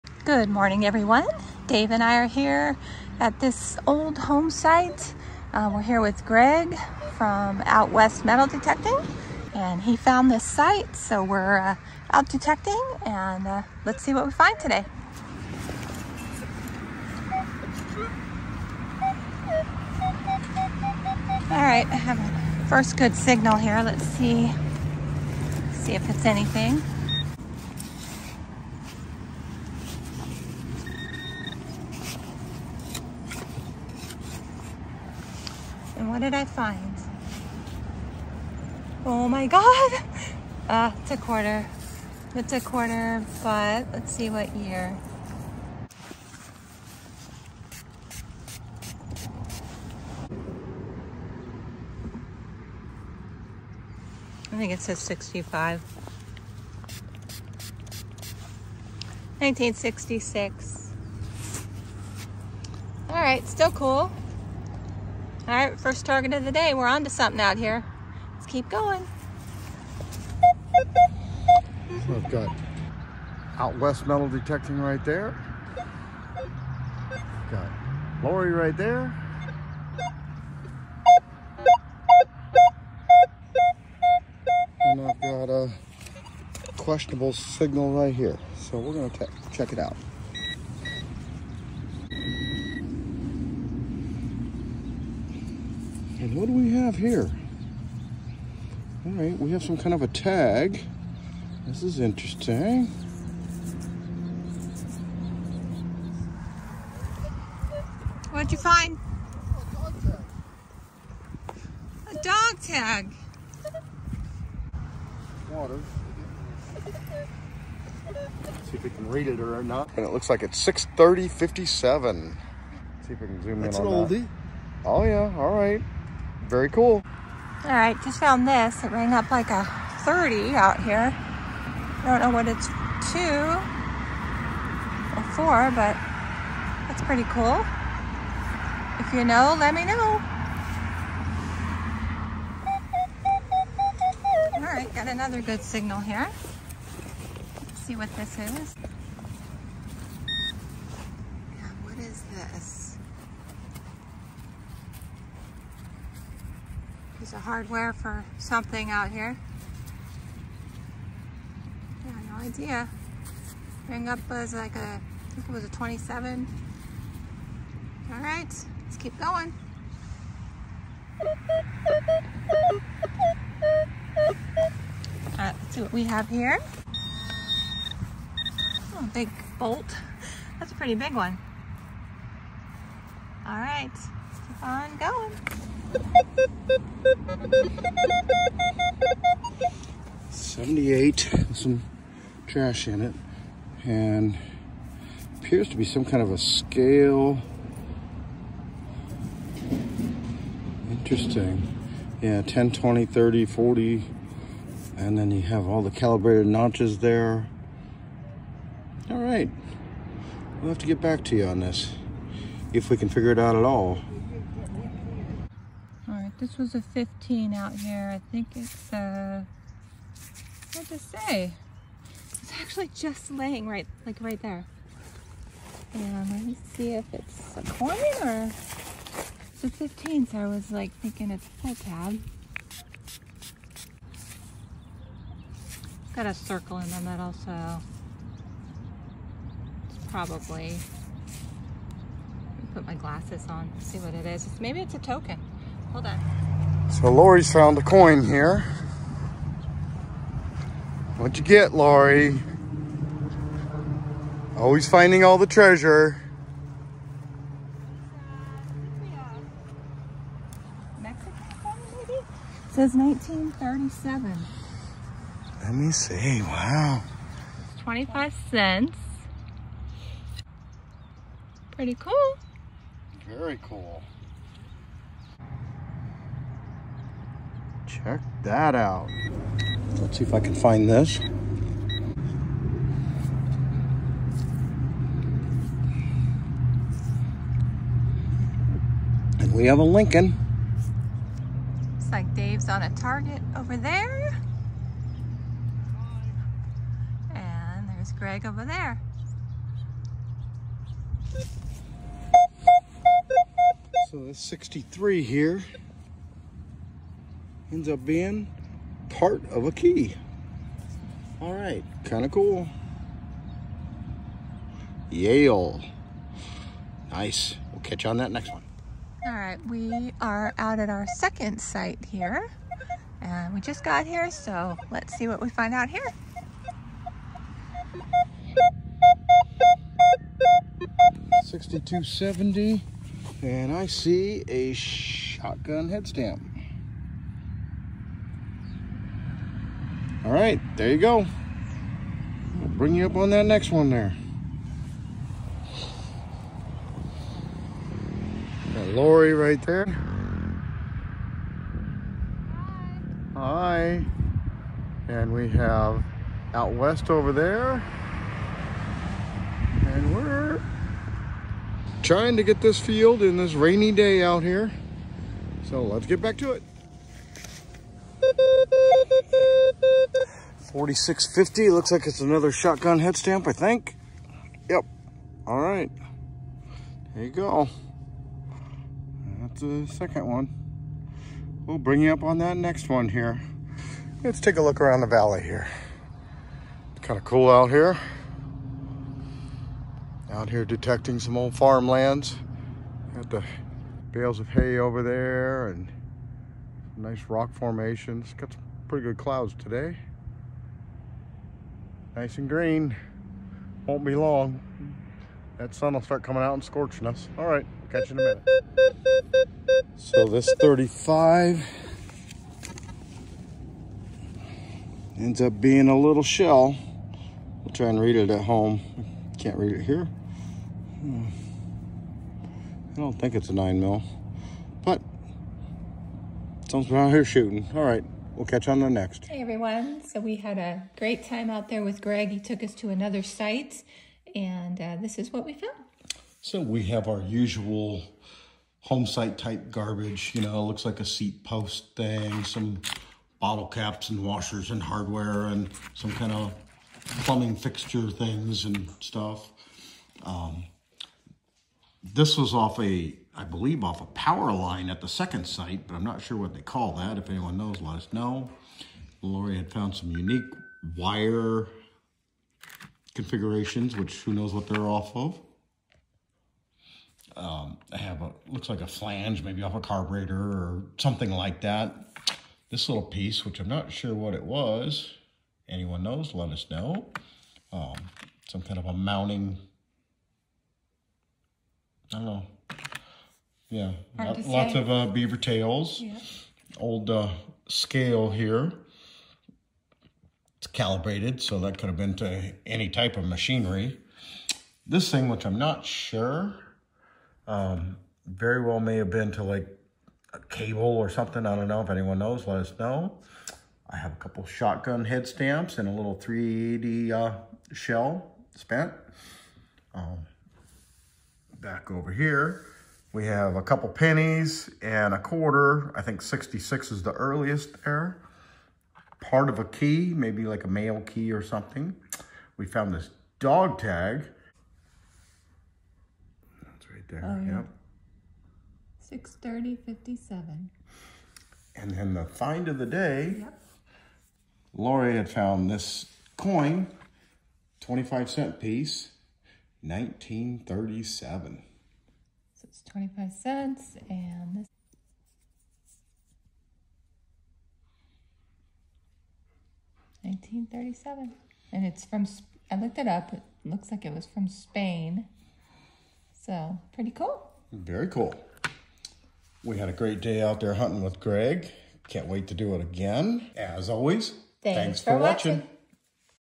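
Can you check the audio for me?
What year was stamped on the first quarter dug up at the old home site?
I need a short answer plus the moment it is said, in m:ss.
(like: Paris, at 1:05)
1966, at 0:59.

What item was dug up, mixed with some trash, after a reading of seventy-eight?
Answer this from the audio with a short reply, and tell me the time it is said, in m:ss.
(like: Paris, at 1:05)
A scale, at 3:15.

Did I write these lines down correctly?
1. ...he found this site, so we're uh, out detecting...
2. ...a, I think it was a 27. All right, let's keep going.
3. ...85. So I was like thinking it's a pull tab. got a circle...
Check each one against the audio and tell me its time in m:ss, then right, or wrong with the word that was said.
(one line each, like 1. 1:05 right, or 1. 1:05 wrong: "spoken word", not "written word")
1. 0:09 right
2. 2:44 right
3. 3:49 wrong: "15", not "85".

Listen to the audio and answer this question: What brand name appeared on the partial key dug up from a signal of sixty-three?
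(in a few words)
Yale.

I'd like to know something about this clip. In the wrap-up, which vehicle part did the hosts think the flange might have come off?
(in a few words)
Carburetor.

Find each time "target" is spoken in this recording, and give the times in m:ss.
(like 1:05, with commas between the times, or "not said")
1:06, 4:52.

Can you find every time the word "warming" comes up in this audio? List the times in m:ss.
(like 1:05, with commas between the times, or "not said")
not said.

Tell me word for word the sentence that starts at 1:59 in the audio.
And it looks like it's 630.57.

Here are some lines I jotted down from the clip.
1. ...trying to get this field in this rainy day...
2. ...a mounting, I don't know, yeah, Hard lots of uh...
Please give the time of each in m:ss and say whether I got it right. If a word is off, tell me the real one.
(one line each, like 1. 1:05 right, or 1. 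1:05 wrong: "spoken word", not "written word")
1. 6:02 right
2. 7:58 right.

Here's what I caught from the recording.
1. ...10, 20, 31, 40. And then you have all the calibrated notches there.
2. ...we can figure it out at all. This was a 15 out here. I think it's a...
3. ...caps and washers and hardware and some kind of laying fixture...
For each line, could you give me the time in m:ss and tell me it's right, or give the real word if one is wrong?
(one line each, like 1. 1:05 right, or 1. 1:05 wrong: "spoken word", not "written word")
1. 3:22 wrong: "30", not "31"
2. 3:32 right
3. 7:23 wrong: "plumbing", not "laying".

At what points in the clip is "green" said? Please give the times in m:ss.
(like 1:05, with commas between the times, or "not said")
6:42.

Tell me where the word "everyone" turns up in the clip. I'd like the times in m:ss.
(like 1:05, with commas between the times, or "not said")
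0:00, 7:09.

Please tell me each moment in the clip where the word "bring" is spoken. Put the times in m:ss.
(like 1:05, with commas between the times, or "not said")
5:42, 6:21.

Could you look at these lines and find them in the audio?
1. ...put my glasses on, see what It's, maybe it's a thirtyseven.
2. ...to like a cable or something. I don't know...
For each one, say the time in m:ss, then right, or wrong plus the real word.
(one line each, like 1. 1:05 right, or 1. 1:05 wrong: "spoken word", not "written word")
1. 4:02 wrong: "token", not "thirtyseven"
2. 8:19 right.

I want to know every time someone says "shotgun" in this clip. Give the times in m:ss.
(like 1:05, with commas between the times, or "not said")
5:34, 6:12, 8:24.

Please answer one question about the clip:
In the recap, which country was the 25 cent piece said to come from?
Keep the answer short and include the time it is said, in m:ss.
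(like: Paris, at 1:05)
Spain, at 9:14.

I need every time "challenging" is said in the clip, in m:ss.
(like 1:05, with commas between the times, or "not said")
not said.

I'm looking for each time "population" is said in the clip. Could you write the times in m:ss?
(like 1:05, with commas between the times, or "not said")
not said.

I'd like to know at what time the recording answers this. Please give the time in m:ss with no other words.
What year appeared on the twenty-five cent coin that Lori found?
4:22.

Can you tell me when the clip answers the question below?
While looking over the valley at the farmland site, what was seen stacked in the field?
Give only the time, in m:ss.
6:34.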